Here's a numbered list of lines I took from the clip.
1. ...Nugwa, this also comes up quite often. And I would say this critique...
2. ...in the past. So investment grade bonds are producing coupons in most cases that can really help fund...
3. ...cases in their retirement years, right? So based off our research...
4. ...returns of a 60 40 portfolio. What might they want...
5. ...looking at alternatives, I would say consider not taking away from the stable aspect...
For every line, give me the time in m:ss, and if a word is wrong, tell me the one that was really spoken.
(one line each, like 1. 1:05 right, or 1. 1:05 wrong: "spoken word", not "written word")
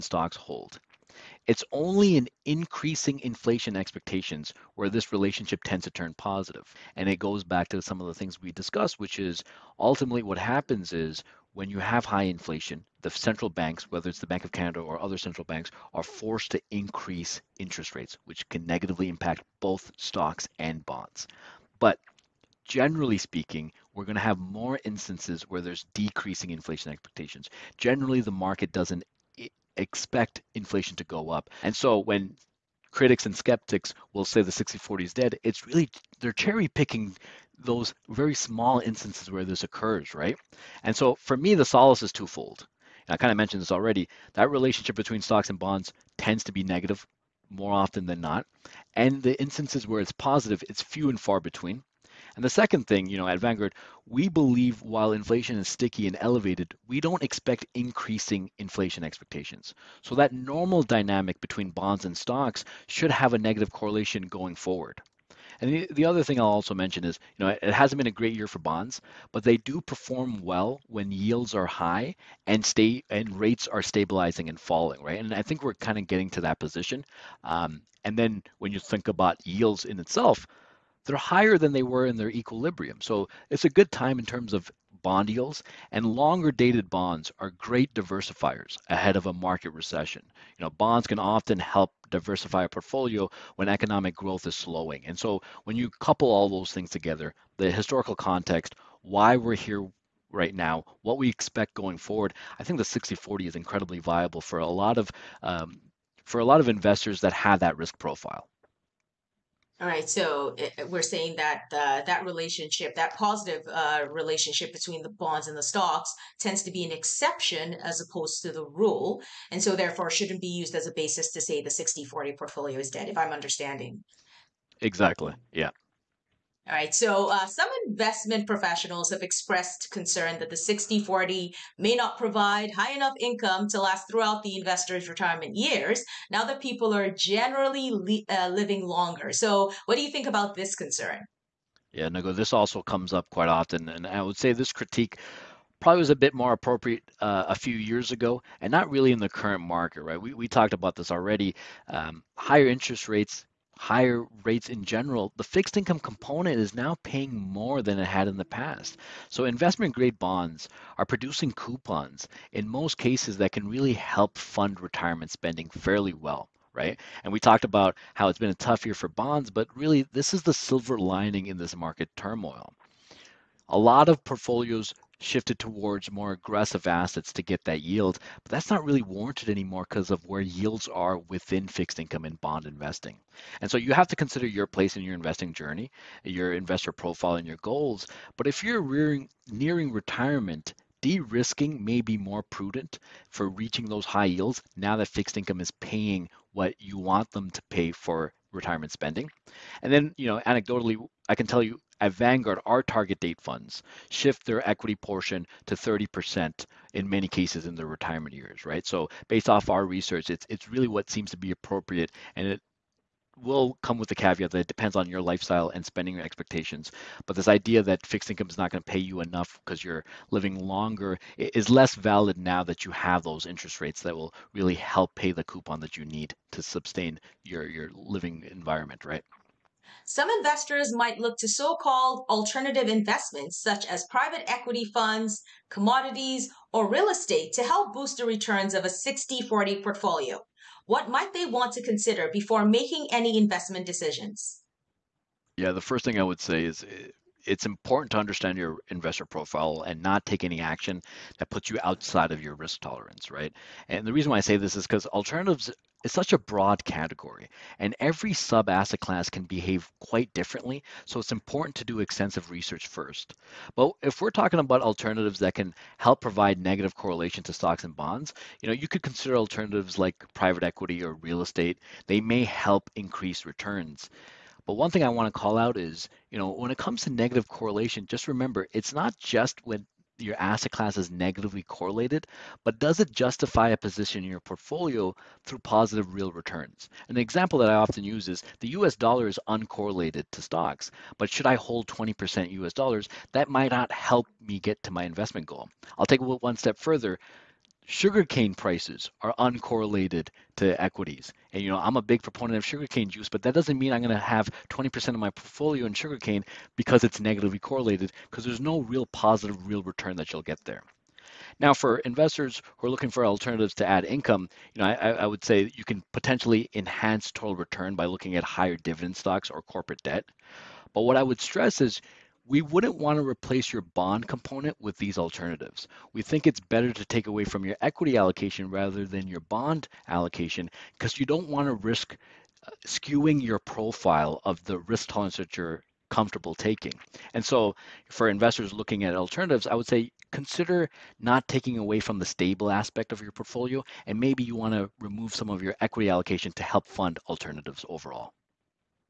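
1. 2:22 right
2. 2:38 right
3. 3:27 right
4. 3:58 right
5. 5:38 right.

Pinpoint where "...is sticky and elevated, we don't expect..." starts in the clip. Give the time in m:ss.
0:55.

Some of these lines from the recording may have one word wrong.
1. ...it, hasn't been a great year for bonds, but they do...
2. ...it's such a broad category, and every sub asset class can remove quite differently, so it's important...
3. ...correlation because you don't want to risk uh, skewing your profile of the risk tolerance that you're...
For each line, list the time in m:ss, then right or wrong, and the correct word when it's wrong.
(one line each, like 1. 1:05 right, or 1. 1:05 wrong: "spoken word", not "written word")
1. 1:07 right
2. 4:16 wrong: "behave", not "remove"
3. 5:30 wrong: "allocation", not "correlation".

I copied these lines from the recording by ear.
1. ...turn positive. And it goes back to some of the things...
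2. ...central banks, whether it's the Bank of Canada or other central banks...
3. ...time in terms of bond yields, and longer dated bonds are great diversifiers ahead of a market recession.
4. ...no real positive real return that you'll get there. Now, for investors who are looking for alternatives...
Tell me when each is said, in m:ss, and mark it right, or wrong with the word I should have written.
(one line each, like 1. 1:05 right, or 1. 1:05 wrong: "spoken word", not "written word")
1. 0:05 right
2. 0:13 right
3. 1:23 right
4. 5:08 right.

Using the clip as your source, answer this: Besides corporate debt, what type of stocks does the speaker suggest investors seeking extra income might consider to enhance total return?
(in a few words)
Higher dividend stocks.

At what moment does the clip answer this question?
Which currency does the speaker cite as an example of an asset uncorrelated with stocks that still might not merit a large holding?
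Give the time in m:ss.
4:48.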